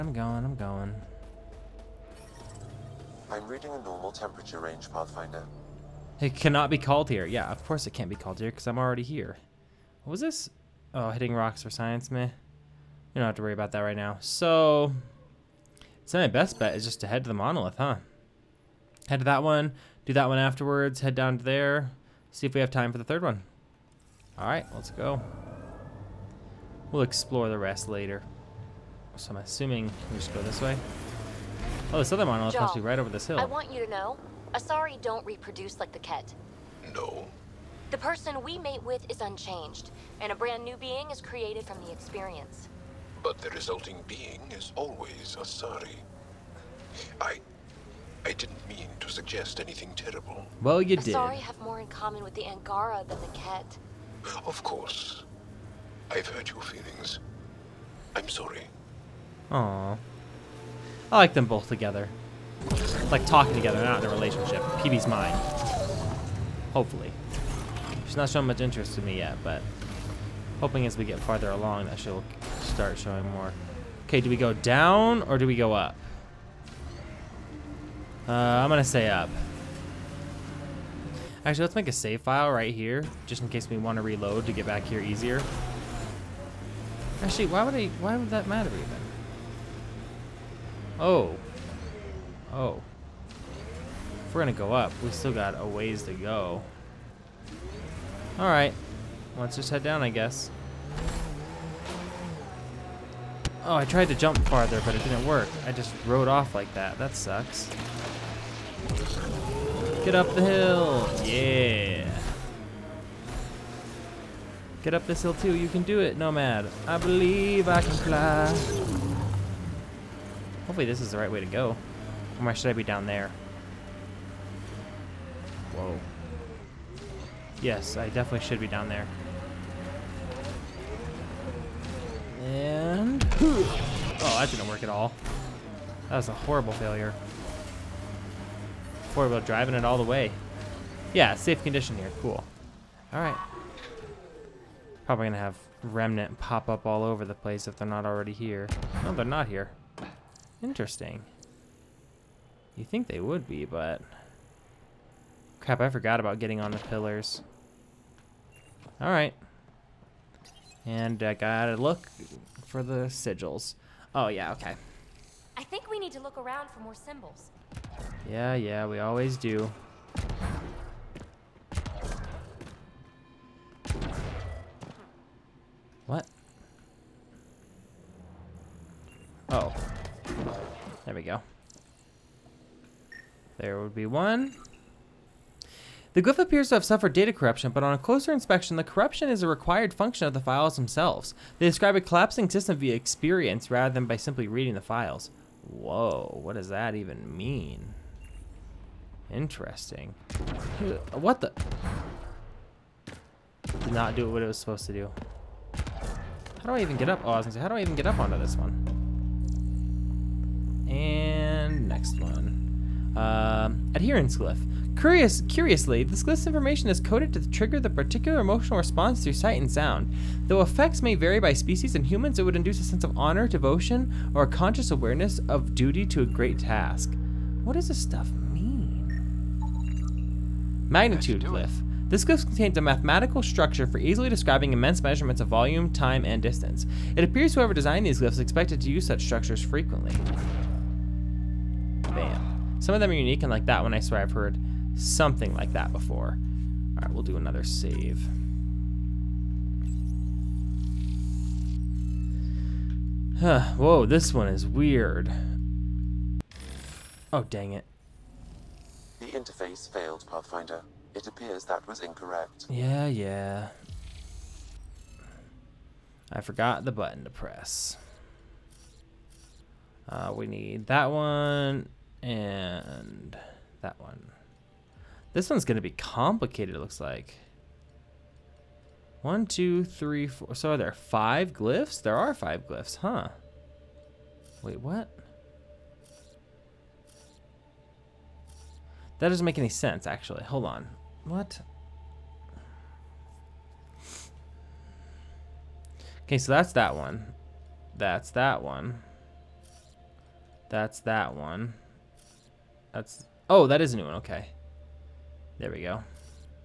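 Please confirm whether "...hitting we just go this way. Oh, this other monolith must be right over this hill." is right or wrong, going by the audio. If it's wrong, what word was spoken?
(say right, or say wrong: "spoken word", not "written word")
wrong: "assuming", not "hitting".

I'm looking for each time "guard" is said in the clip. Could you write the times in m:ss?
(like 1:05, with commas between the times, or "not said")
not said.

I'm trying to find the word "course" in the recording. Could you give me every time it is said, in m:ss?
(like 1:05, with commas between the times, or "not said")
0:07, 0:54.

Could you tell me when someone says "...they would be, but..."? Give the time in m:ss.
2:33.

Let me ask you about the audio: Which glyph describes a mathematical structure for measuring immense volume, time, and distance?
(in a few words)
Magnitude glyph.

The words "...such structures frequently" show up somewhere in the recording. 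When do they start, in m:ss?
3:59.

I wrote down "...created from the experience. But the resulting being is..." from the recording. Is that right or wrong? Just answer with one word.
right.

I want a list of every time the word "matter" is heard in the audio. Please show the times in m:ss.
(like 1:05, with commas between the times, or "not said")
1:28.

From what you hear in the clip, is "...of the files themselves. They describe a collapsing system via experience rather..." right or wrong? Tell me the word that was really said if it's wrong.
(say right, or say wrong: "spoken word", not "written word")
right.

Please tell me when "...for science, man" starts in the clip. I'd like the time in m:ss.
0:11.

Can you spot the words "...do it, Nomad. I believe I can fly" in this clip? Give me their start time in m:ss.
1:55.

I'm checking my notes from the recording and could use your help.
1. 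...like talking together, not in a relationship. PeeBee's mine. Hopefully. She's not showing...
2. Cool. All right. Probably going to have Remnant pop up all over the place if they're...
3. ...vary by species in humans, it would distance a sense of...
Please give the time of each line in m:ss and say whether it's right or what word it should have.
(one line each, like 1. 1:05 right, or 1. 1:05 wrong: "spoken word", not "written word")
1. 1:03 right
2. 2:22 right
3. 3:41 wrong: "induce", not "distance".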